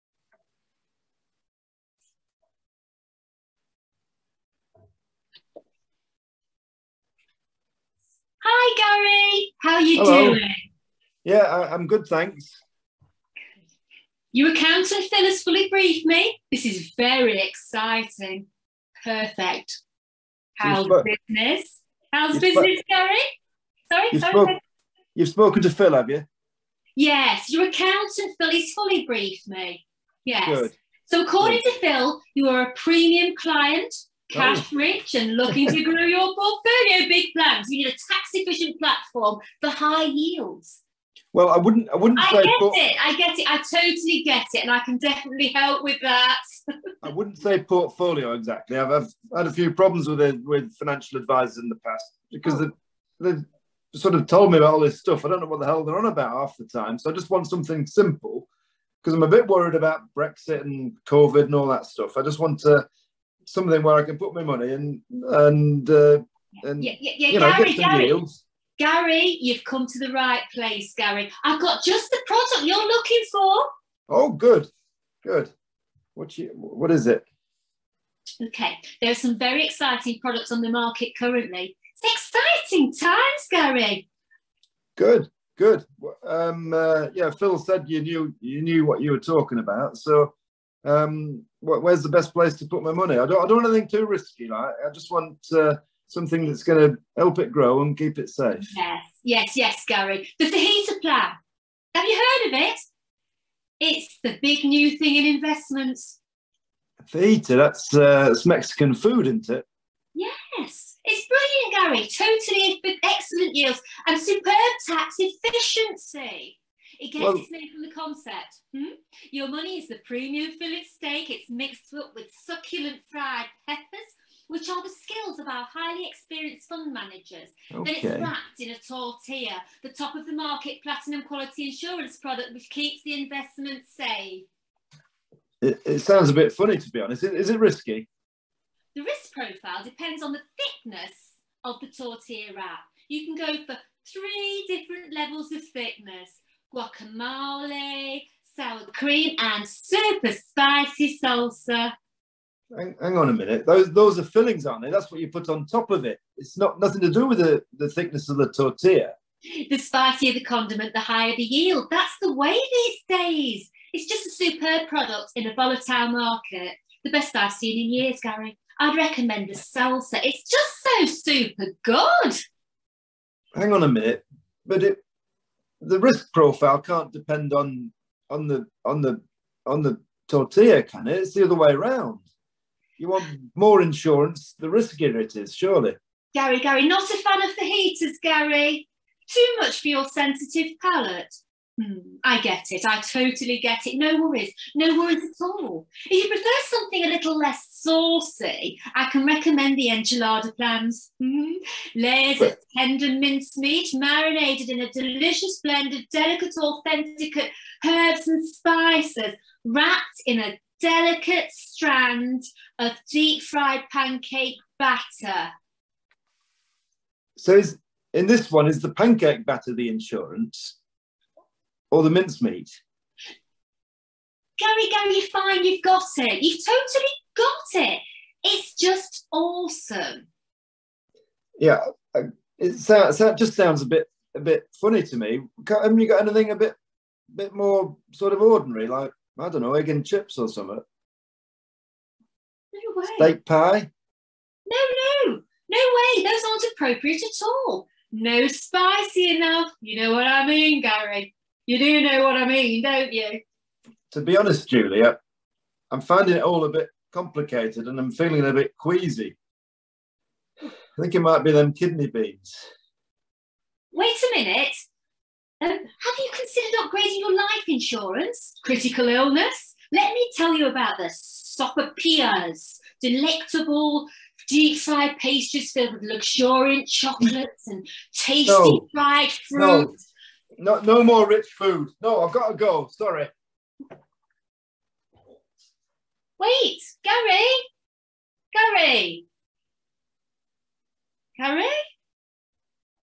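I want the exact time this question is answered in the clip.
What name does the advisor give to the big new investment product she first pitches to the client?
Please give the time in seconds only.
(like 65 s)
100 s.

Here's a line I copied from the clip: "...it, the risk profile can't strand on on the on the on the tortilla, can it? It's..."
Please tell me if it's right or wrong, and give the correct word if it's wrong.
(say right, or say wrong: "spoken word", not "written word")
wrong: "depend", not "strand".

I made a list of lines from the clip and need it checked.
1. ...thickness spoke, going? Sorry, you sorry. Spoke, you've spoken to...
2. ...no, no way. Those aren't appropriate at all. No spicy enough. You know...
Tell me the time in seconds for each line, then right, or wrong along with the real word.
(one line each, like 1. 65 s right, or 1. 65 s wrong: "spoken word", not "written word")
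1. 22 s wrong: "business", not "thickness"
2. 245 s right.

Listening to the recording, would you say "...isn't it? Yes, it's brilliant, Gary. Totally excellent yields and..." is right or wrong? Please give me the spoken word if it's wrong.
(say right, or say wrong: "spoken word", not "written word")
right.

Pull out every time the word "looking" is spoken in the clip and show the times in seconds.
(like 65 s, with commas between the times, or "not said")
35 s, 72 s.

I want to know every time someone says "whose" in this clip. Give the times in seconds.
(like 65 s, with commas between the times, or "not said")
not said.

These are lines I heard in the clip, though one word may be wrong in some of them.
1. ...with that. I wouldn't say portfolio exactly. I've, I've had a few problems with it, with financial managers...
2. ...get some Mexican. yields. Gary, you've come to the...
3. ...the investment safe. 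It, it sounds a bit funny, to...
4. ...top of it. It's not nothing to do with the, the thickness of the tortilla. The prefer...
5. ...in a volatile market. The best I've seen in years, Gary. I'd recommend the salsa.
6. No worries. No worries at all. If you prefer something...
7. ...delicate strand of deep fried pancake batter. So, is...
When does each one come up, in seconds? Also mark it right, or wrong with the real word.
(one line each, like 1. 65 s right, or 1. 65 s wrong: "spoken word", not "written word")
1. 45 s wrong: "advisors", not "managers"
2. 67 s wrong: "Gary", not "Mexican"
3. 133 s right
4. 155 s wrong: "spicier", not "prefer"
5. 165 s right
6. 193 s right
7. 210 s right.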